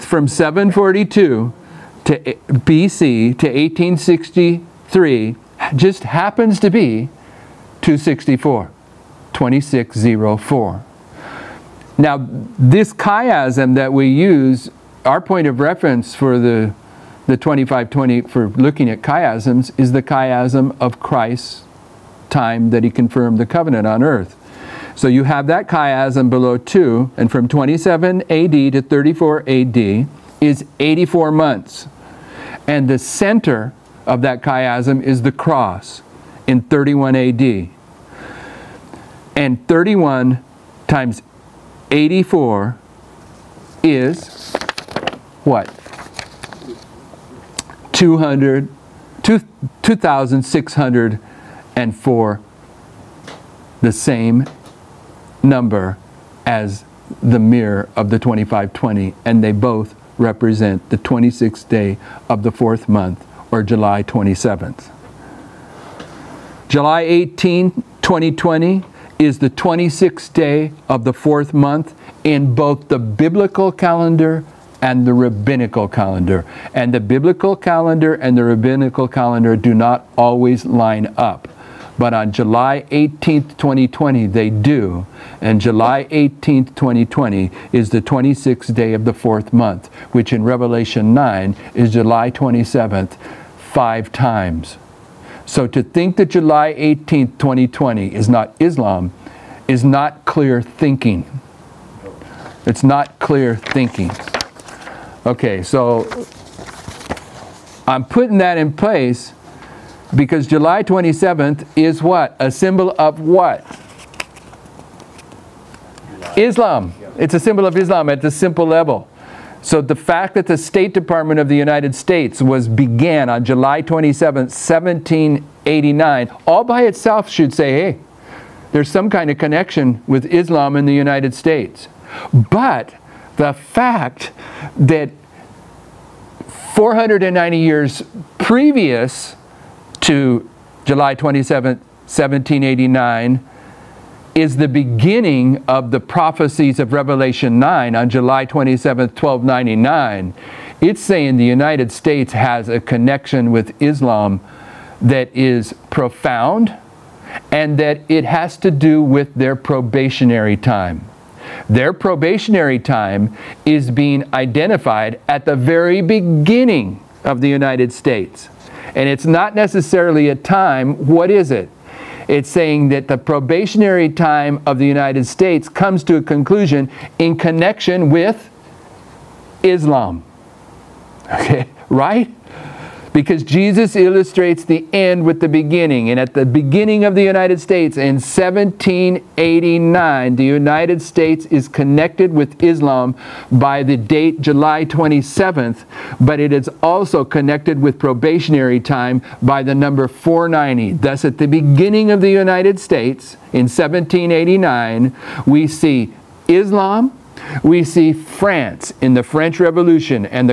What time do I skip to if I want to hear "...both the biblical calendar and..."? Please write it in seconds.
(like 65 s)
72 s.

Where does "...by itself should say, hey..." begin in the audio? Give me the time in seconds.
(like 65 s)
126 s.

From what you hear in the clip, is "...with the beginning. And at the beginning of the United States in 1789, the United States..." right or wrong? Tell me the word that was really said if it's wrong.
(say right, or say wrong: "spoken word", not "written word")
right.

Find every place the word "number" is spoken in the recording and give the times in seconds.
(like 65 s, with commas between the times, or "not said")
55 s, 199 s.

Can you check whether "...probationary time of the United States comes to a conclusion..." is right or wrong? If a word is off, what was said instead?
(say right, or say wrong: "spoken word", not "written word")
right.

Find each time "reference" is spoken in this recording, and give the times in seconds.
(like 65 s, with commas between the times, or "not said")
15 s.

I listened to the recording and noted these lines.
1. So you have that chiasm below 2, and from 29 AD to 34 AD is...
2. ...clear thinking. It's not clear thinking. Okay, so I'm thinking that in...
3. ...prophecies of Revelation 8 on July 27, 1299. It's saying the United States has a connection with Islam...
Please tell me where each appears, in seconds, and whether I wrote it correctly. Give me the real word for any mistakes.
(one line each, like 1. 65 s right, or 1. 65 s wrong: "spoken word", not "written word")
1. 24 s wrong: "27", not "29"
2. 100 s wrong: "putting", not "thinking"
3. 146 s wrong: "9", not "8".